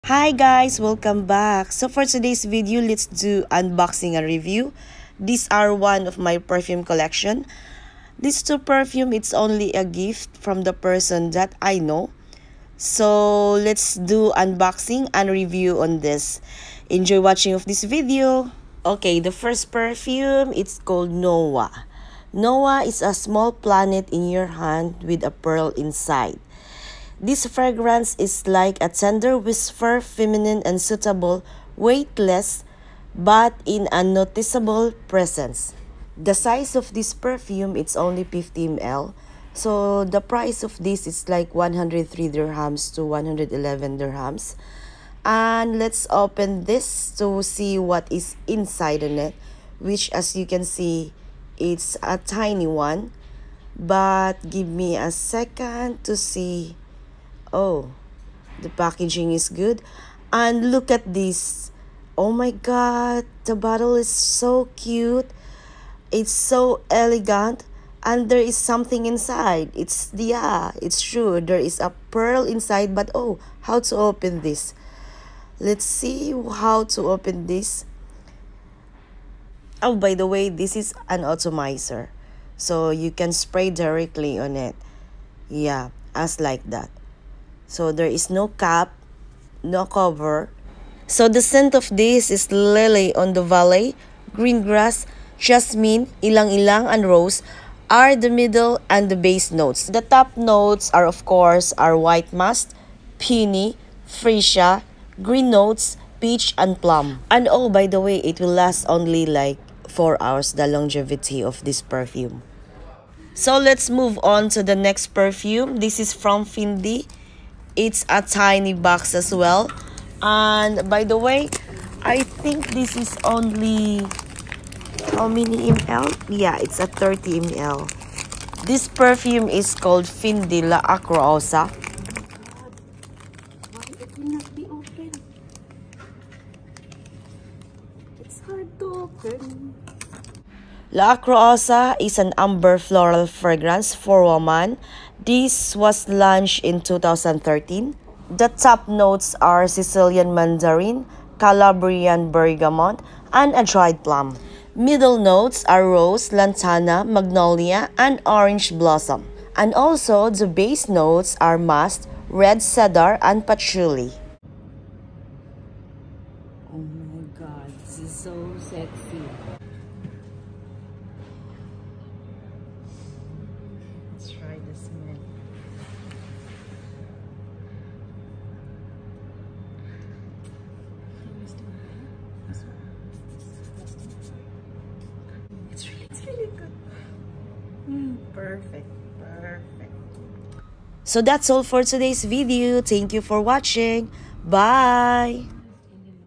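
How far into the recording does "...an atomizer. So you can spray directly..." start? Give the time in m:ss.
1:21.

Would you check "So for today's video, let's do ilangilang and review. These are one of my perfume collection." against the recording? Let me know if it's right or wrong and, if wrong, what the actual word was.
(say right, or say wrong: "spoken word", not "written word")
wrong: "unboxing", not "ilangilang".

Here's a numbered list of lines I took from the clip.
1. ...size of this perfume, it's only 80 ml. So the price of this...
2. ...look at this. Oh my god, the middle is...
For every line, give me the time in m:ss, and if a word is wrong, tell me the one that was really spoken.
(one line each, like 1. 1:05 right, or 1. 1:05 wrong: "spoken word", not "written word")
1. 0:36 wrong: "50", not "80"
2. 1:00 wrong: "bottle", not "middle".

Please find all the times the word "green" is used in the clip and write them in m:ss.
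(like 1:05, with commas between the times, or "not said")
1:34, 1:45.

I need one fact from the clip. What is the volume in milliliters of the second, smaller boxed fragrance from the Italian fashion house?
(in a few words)
30 ml.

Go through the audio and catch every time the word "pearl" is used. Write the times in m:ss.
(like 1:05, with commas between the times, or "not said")
0:25, 1:12.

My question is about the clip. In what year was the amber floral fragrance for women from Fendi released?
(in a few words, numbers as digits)
2013.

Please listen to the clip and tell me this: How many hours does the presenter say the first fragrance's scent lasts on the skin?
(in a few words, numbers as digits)
4 hours.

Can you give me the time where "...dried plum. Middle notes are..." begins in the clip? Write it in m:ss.
2:33.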